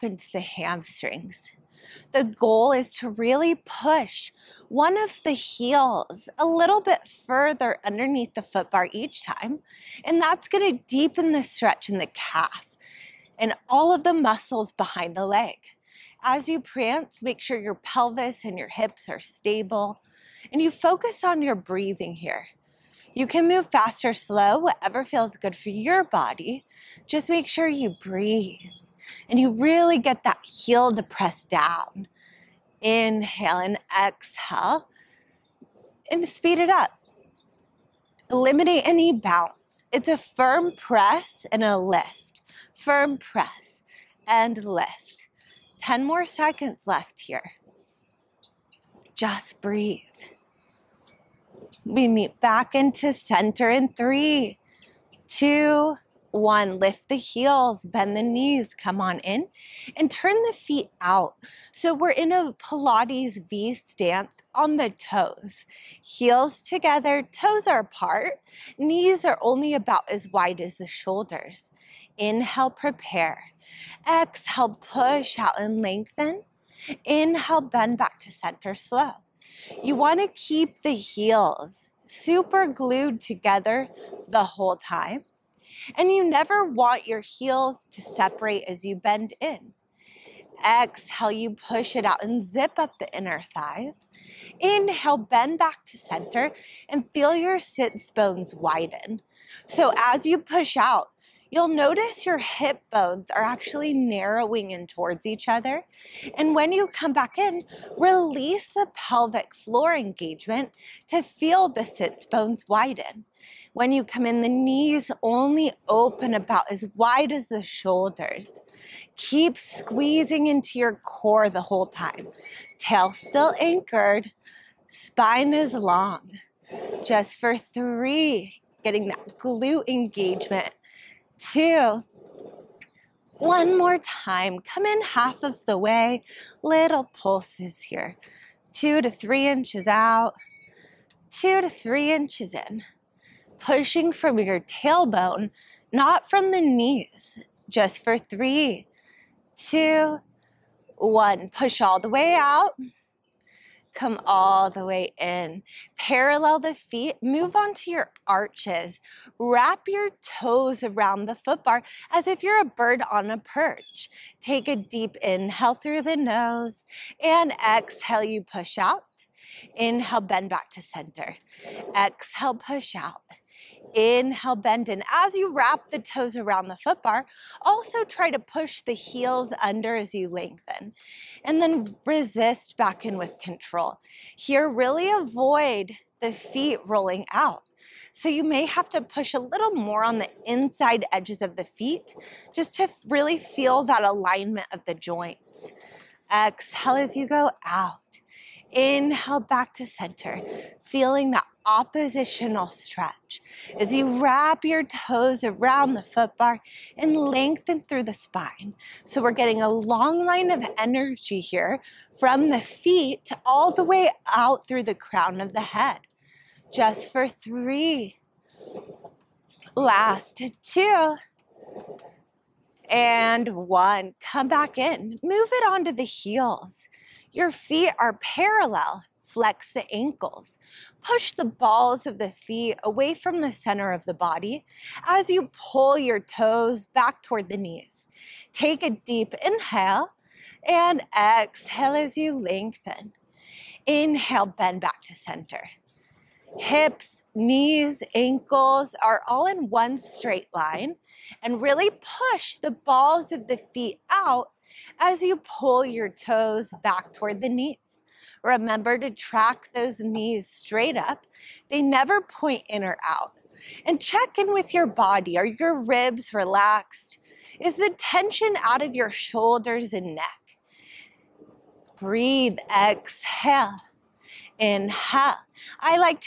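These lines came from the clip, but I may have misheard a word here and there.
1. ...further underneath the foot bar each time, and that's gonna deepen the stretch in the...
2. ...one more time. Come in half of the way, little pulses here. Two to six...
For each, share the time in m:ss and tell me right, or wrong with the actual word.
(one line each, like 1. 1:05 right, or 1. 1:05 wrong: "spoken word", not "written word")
1. 0:07 right
2. 2:13 wrong: "three", not "six".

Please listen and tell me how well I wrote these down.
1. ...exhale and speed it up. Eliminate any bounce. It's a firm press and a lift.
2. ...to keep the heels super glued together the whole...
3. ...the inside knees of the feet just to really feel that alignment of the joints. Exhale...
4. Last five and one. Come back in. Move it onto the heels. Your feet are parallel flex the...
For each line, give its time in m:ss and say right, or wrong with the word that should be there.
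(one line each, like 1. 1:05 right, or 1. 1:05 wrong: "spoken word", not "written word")
1. 0:33 right
2. 1:20 right
3. 3:10 wrong: "edges", not "knees"
4. 3:39 wrong: "two", not "five".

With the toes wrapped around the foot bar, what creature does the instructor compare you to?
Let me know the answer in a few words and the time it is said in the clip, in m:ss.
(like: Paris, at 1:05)
a bird on a perch, at 2:42.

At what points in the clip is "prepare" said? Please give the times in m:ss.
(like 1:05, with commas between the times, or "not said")
1:12.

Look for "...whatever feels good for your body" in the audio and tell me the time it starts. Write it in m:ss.
0:24.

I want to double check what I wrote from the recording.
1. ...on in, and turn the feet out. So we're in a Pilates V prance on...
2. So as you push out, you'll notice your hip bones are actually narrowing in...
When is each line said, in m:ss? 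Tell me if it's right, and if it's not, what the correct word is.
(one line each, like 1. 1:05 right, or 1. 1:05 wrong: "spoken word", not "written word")
1. 0:58 wrong: "stance", not "prance"
2. 1:39 right.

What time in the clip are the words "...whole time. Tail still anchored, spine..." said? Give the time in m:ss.
2:01.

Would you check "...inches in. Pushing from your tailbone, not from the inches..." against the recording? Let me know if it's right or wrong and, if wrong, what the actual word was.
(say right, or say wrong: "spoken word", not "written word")
wrong: "knees", not "inches".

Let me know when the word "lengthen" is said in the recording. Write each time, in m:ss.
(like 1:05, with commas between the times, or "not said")
1:15, 3:00, 3:27, 4:02.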